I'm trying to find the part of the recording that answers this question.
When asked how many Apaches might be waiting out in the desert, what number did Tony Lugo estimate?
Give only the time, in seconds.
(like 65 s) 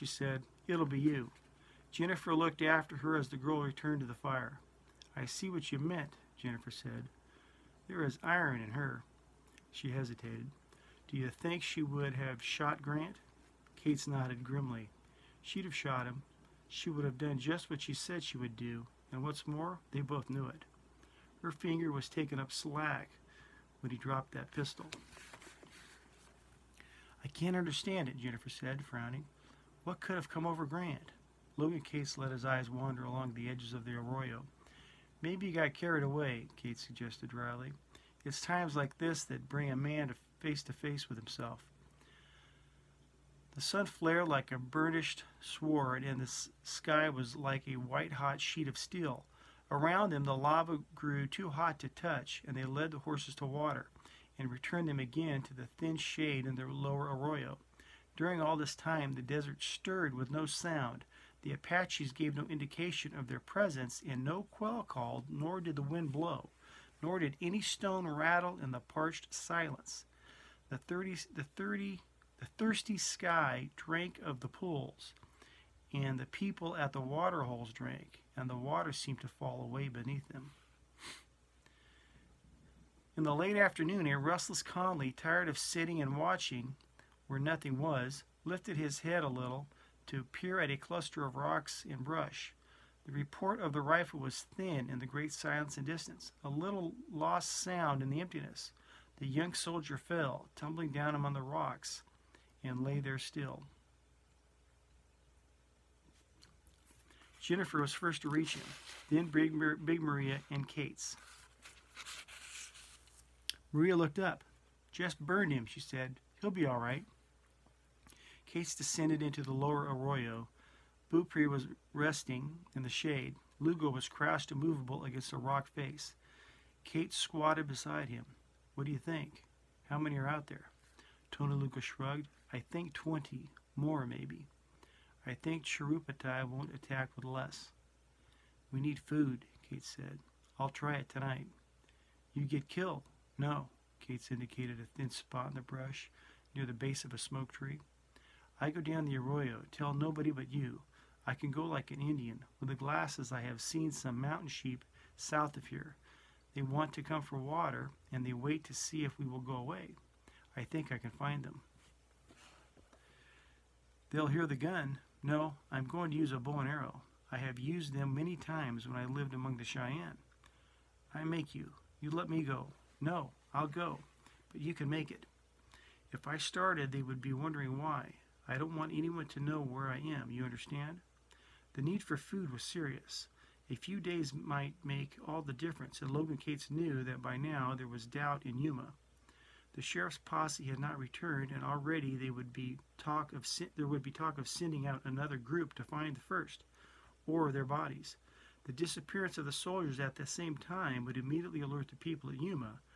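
132 s.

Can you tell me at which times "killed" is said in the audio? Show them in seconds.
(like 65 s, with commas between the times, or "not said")
142 s.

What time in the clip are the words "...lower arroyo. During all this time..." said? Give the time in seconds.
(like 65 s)
56 s.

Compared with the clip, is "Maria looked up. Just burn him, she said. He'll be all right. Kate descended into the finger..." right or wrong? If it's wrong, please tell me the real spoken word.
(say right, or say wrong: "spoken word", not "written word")
wrong: "lower", not "finger".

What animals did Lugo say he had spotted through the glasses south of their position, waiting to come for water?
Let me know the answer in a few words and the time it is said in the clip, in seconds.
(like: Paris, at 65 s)
Mountain sheep, at 154 s.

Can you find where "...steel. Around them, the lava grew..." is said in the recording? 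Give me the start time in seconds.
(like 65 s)
48 s.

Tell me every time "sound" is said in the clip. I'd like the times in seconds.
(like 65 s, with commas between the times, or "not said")
60 s, 97 s.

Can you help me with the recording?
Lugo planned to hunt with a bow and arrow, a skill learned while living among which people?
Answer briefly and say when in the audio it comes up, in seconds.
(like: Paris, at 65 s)
The Cheyenne, at 169 s.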